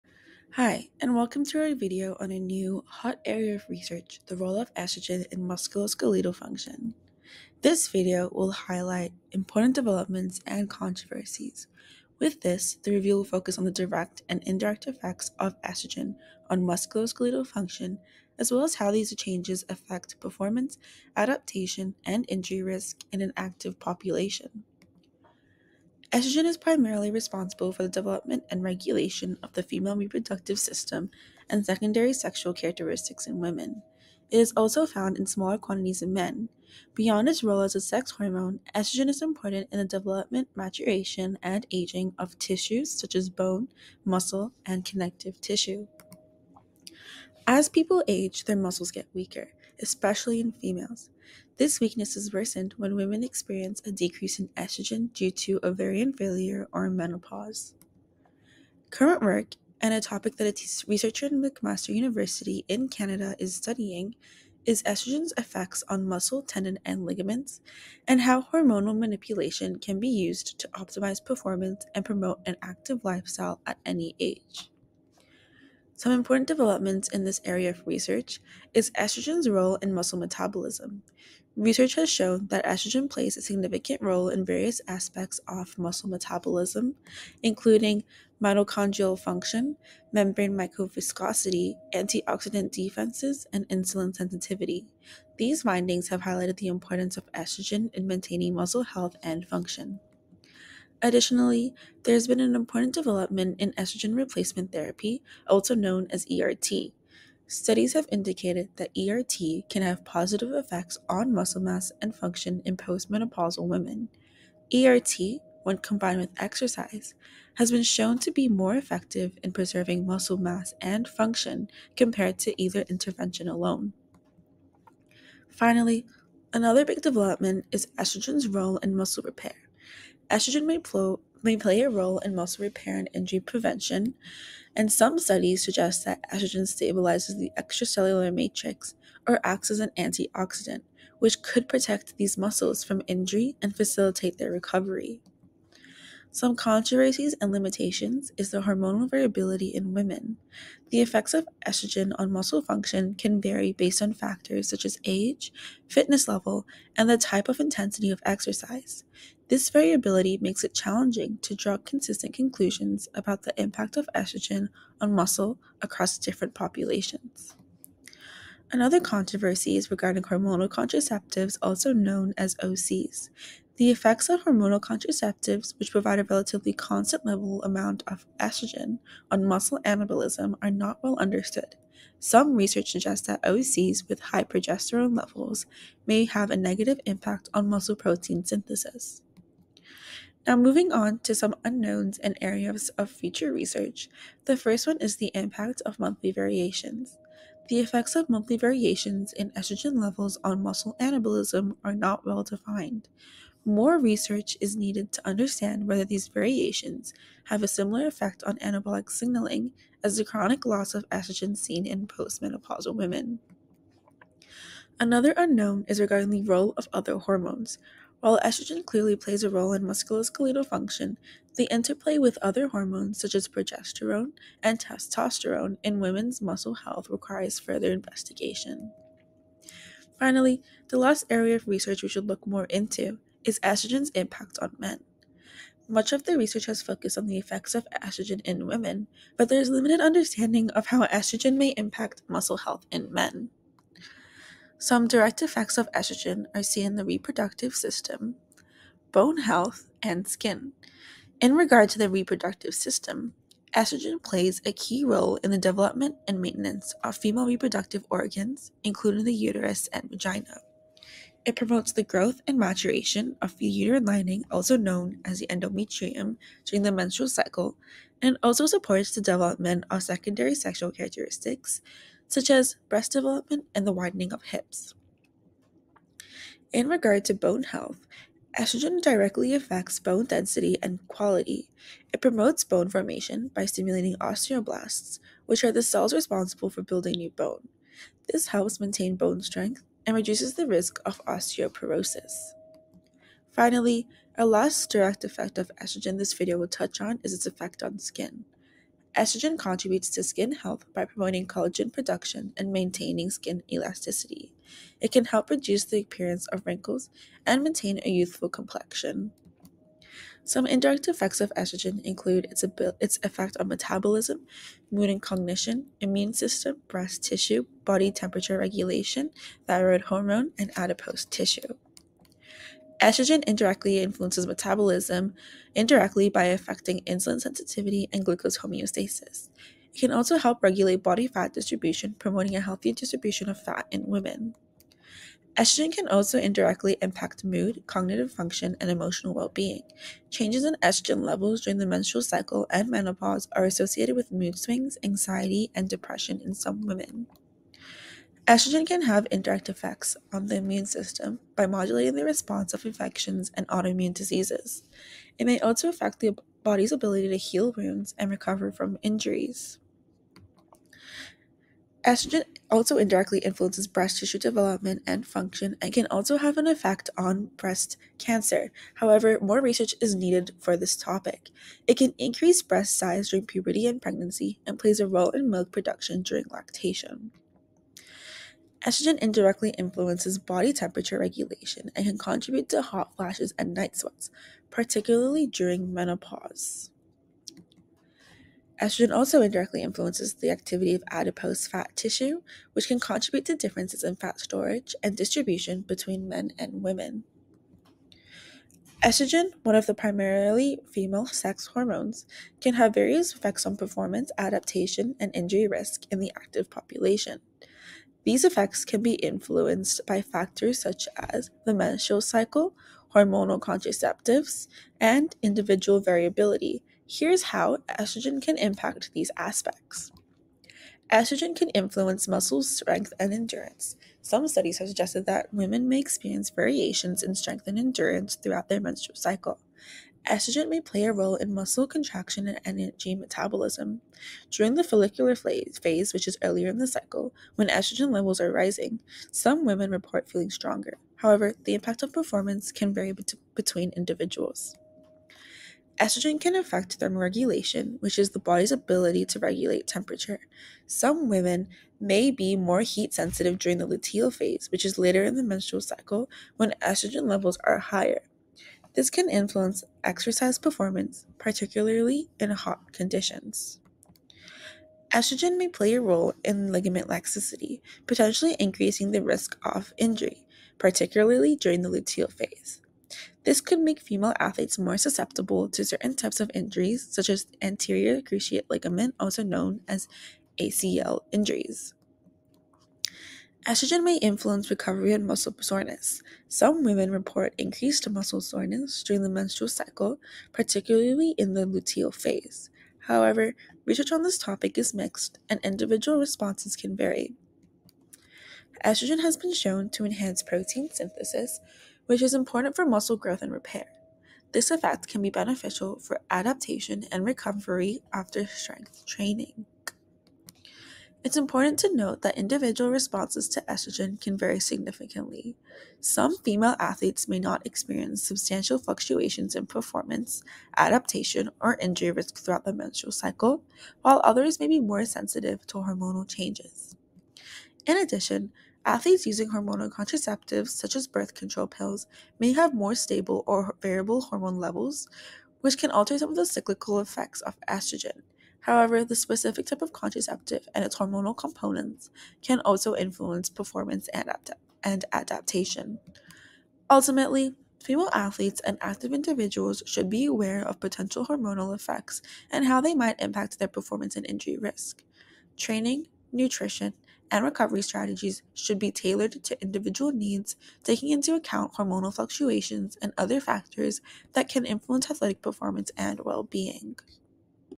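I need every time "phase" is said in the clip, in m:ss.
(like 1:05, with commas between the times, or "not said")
7:15, 7:34, 7:52, 8:12.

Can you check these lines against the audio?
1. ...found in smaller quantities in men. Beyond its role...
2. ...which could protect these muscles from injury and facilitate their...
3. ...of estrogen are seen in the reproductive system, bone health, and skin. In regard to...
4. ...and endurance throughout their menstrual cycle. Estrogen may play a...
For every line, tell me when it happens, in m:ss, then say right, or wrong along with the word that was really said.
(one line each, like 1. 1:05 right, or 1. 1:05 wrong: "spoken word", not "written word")
1. 0:34 right
2. 2:21 right
3. 4:05 right
4. 7:07 right.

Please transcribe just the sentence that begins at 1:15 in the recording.
Some important developments in this area of research is estrogen's role in muscle metabolism.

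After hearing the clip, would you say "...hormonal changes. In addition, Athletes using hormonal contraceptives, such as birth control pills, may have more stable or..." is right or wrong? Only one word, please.
right.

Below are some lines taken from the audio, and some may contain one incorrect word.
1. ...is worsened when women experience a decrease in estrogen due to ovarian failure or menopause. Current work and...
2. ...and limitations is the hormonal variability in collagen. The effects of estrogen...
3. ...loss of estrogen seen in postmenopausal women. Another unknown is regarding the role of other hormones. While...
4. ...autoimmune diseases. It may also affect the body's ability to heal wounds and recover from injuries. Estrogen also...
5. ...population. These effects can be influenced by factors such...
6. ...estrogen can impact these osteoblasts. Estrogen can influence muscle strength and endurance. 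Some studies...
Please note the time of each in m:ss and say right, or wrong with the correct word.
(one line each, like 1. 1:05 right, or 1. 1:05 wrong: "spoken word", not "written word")
1. 0:52 right
2. 2:27 wrong: "women", not "collagen"
3. 3:30 right
4. 5:53 right
5. 6:46 right
6. 6:57 wrong: "aspects", not "osteoblasts".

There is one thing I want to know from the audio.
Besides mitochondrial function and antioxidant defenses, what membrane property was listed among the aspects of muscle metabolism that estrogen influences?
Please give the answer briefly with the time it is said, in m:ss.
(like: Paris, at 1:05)
Membrane microviscosity, at 1:30.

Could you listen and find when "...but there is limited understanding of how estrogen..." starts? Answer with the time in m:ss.
3:59.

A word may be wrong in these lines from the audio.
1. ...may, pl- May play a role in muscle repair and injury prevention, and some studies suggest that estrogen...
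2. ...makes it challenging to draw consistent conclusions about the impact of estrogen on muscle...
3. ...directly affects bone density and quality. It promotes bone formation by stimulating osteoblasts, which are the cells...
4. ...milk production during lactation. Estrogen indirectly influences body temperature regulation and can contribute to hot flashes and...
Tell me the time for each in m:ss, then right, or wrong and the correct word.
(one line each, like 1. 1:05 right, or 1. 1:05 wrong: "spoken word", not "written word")
1. 2:10 right
2. 2:40 right
3. 4:39 right
4. 6:15 right.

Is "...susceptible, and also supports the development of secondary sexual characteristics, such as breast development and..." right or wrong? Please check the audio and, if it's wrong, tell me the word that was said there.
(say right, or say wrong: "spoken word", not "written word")
wrong: "cycle", not "susceptible".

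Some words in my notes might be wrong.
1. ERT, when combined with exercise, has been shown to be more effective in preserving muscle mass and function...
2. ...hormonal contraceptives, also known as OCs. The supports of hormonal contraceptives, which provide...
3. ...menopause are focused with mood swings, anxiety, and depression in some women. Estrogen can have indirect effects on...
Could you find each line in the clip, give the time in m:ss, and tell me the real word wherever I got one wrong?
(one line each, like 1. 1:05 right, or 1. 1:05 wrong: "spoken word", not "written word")
1. 1:54 right
2. 2:50 wrong: "effects", not "supports"
3. 5:42 wrong: "associated", not "focused".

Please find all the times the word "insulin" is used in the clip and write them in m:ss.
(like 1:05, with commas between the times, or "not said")
1:33, 5:27.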